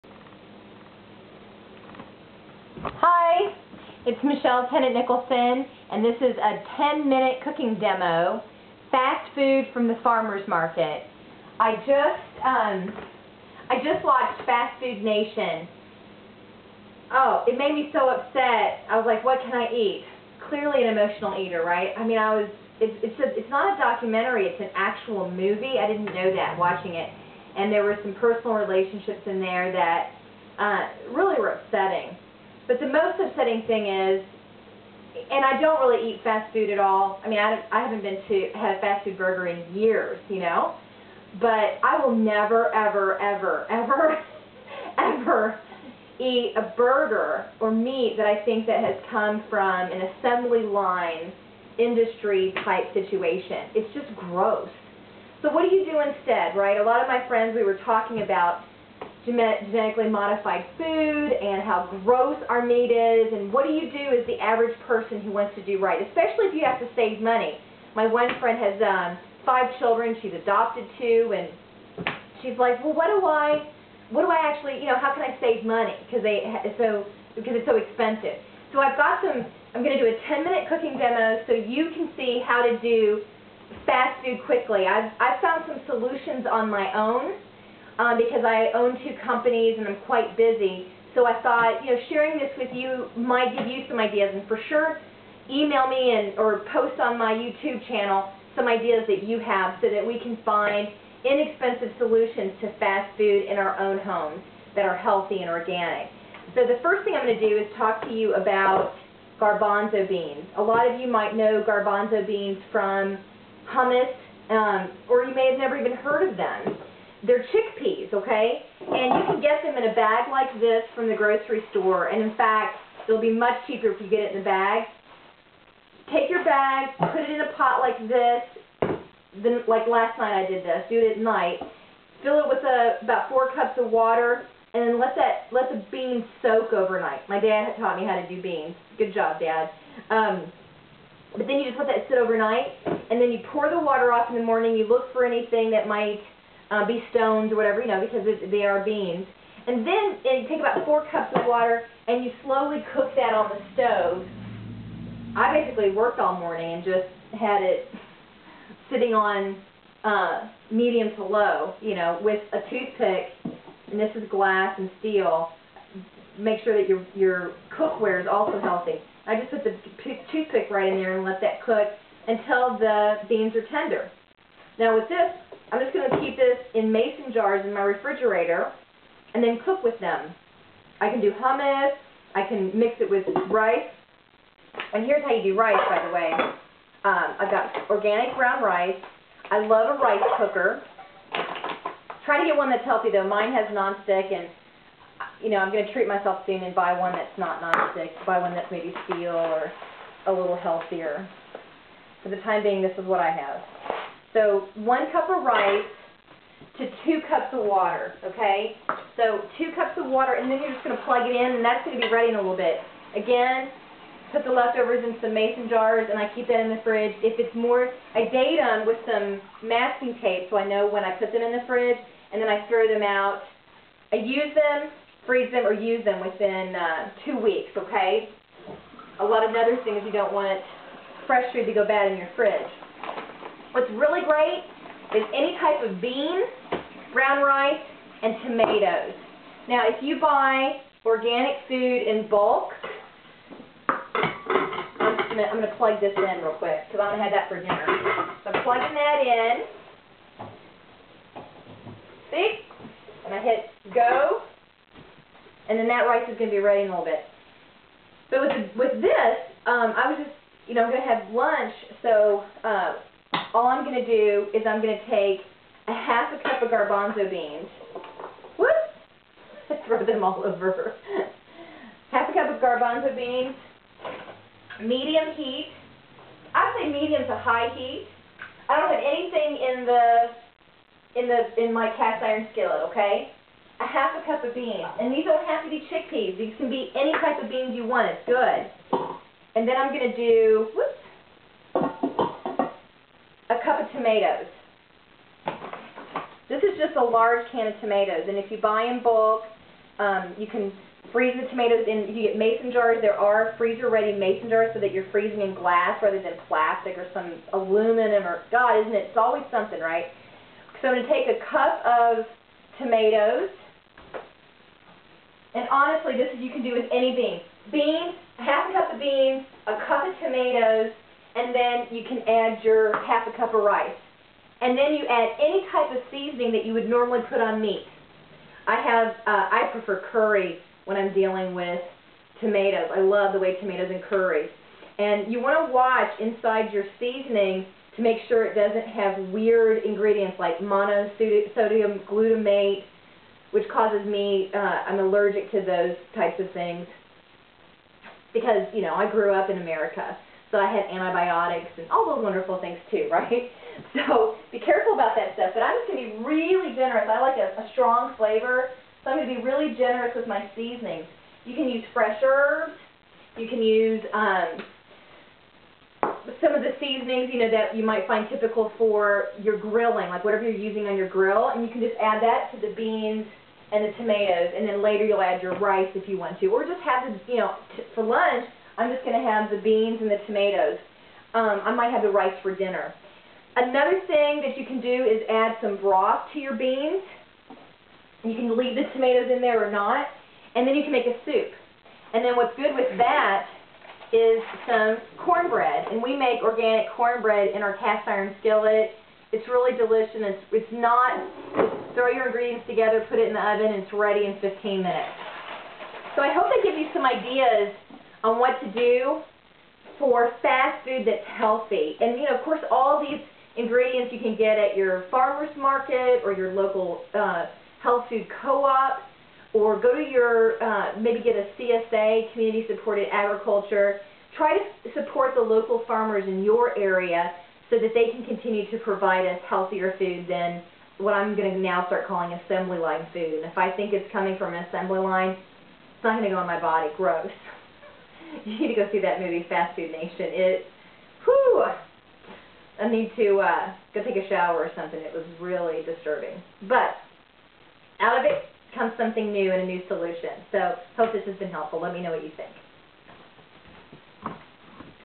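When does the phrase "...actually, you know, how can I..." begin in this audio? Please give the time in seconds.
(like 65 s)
74 s.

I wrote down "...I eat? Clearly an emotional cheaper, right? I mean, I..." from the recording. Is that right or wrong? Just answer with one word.
wrong.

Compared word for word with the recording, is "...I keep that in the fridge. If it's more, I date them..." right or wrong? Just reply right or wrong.
right.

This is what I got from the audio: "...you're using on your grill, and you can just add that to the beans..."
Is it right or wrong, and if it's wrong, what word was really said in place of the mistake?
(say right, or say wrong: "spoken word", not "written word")
right.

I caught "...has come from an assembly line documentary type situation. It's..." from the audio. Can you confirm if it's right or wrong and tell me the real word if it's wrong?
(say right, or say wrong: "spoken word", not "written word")
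wrong: "industry", not "documentary".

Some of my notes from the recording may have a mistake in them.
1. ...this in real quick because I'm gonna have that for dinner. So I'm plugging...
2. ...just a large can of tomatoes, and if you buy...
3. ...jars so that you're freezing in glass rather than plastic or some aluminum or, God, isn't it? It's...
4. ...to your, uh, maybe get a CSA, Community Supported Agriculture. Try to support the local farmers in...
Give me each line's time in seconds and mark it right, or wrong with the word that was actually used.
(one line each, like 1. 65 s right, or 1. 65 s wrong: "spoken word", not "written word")
1. 246 s right
2. 296 s right
3. 304 s right
4. 419 s right.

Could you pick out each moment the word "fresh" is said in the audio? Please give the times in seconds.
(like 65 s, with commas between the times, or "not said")
231 s, 361 s.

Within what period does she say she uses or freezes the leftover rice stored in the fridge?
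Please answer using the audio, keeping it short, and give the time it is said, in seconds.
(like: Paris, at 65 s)
2 weeks, at 227 s.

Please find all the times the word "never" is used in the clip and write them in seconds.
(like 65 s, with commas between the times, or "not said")
42 s, 115 s.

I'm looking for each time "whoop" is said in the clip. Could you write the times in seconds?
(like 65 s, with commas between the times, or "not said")
268 s, 290 s.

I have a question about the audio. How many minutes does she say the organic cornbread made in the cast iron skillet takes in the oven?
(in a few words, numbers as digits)
15.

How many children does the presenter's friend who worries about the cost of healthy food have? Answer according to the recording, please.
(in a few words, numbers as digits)
5.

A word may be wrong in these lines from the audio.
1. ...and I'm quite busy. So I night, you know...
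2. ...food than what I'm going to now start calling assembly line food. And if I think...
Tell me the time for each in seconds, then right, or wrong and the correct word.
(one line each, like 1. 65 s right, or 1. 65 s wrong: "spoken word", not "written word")
1. 89 s wrong: "thought", not "night"
2. 429 s right.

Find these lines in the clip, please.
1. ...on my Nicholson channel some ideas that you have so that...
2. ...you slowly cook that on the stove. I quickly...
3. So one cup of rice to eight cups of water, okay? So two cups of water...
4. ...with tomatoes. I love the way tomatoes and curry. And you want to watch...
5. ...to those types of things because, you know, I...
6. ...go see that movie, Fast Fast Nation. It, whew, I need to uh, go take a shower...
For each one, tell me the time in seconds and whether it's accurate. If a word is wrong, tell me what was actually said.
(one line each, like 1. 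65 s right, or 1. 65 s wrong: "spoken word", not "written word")
1. 96 s wrong: "YouTube", not "Nicholson"
2. 152 s wrong: "basically", not "quickly"
3. 204 s wrong: "two", not "eight"
4. 331 s right
5. 345 s right
6. 438 s wrong: "Food", not "Fast".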